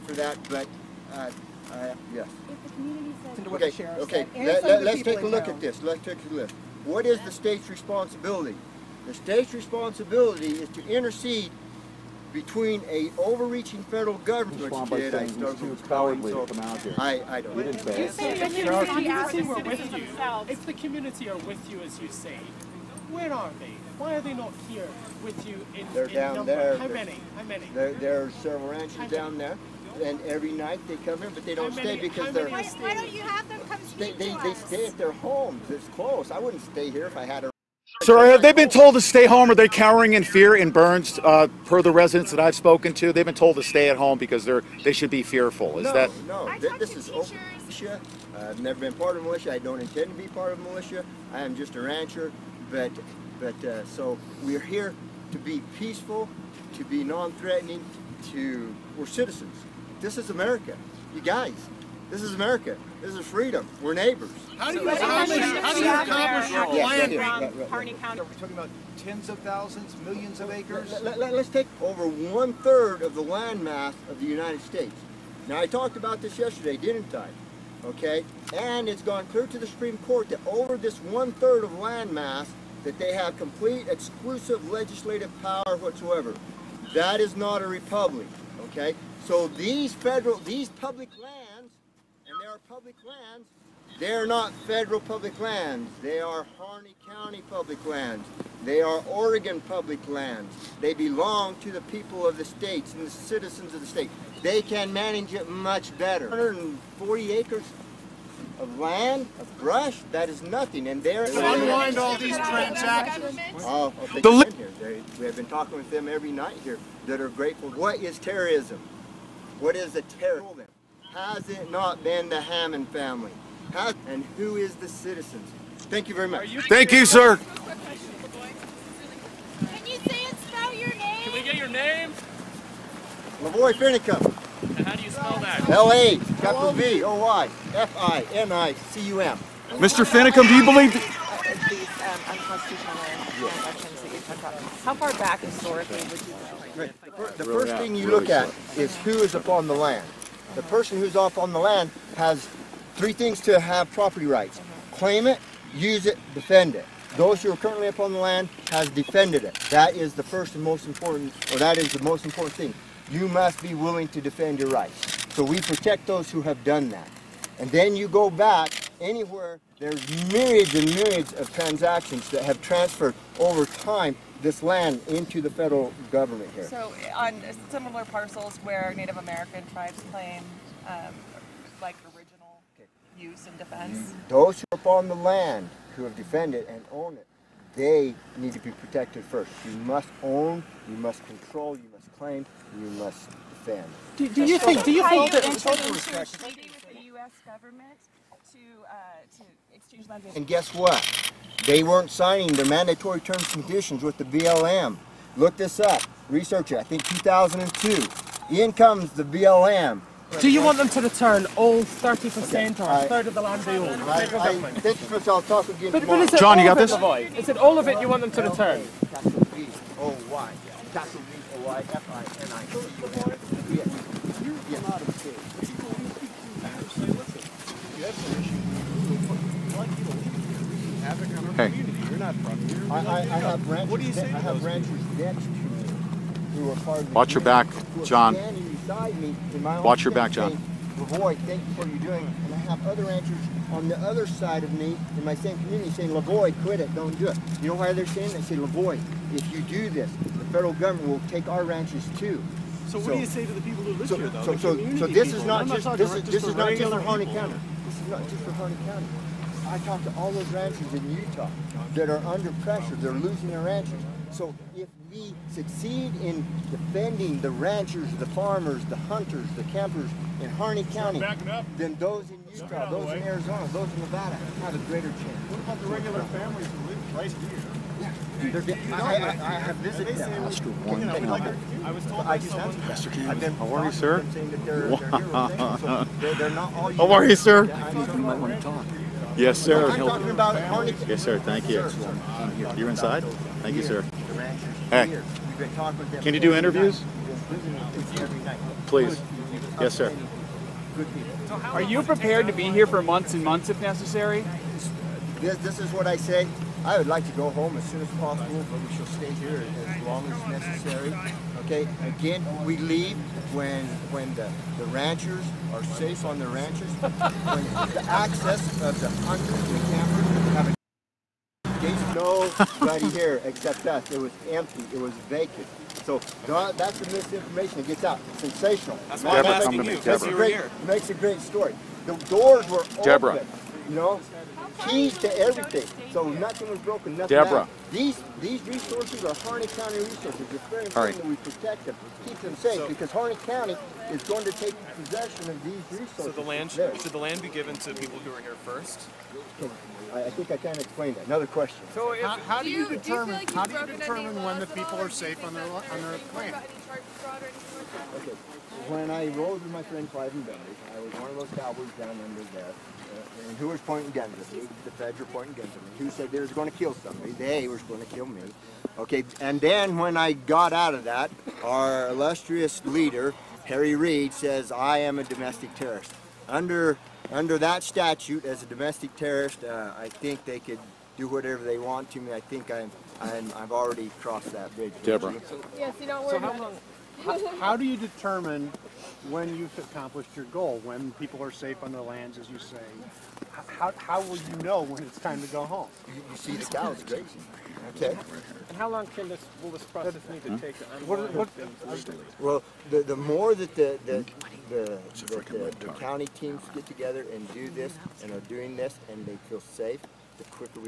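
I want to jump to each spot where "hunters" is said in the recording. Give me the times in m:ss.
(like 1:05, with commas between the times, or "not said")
4:28, 5:19.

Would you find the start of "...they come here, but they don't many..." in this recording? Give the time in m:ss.
0:30.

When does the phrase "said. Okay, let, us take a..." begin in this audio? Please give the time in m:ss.
0:04.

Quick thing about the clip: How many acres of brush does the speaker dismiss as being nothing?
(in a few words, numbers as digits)
140.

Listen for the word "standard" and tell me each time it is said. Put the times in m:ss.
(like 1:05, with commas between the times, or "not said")
not said.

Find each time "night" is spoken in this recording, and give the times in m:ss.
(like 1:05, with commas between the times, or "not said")
0:30, 1:56.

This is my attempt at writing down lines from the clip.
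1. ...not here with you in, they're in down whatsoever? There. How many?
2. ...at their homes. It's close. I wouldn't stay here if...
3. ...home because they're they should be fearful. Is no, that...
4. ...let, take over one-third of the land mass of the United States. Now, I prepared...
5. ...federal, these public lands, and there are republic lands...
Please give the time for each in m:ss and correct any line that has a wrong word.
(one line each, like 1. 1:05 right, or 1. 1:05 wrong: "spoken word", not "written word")
1. 0:24 wrong: "number", not "whatsoever"
2. 0:34 right
3. 0:43 right
4. 1:11 wrong: "talked", not "prepared"
5. 1:29 wrong: "public", not "republic".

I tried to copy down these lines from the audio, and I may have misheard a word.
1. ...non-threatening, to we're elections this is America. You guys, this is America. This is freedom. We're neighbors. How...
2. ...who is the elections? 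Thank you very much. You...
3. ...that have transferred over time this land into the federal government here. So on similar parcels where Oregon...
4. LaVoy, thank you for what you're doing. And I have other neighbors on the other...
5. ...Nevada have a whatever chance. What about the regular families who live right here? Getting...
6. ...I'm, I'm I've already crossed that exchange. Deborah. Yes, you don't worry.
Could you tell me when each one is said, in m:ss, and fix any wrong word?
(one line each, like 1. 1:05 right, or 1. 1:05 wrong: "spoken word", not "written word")
1. 0:57 wrong: "citizens", not "elections"
2. 2:04 wrong: "citizens", not "elections"
3. 2:52 wrong: "Native", not "Oregon"
4. 4:00 wrong: "ranchers", not "neighbors"
5. 4:33 wrong: "greater", not "whatever"
6. 6:22 wrong: "bridge", not "exchange".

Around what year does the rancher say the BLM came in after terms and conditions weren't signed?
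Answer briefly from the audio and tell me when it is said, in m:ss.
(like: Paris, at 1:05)
2002, at 3:27.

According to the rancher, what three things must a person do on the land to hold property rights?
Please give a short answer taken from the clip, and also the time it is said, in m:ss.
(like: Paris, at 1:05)
Claim it, use it, defend it, at 2:34.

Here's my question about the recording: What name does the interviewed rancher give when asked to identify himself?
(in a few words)
LaVoy Finicum.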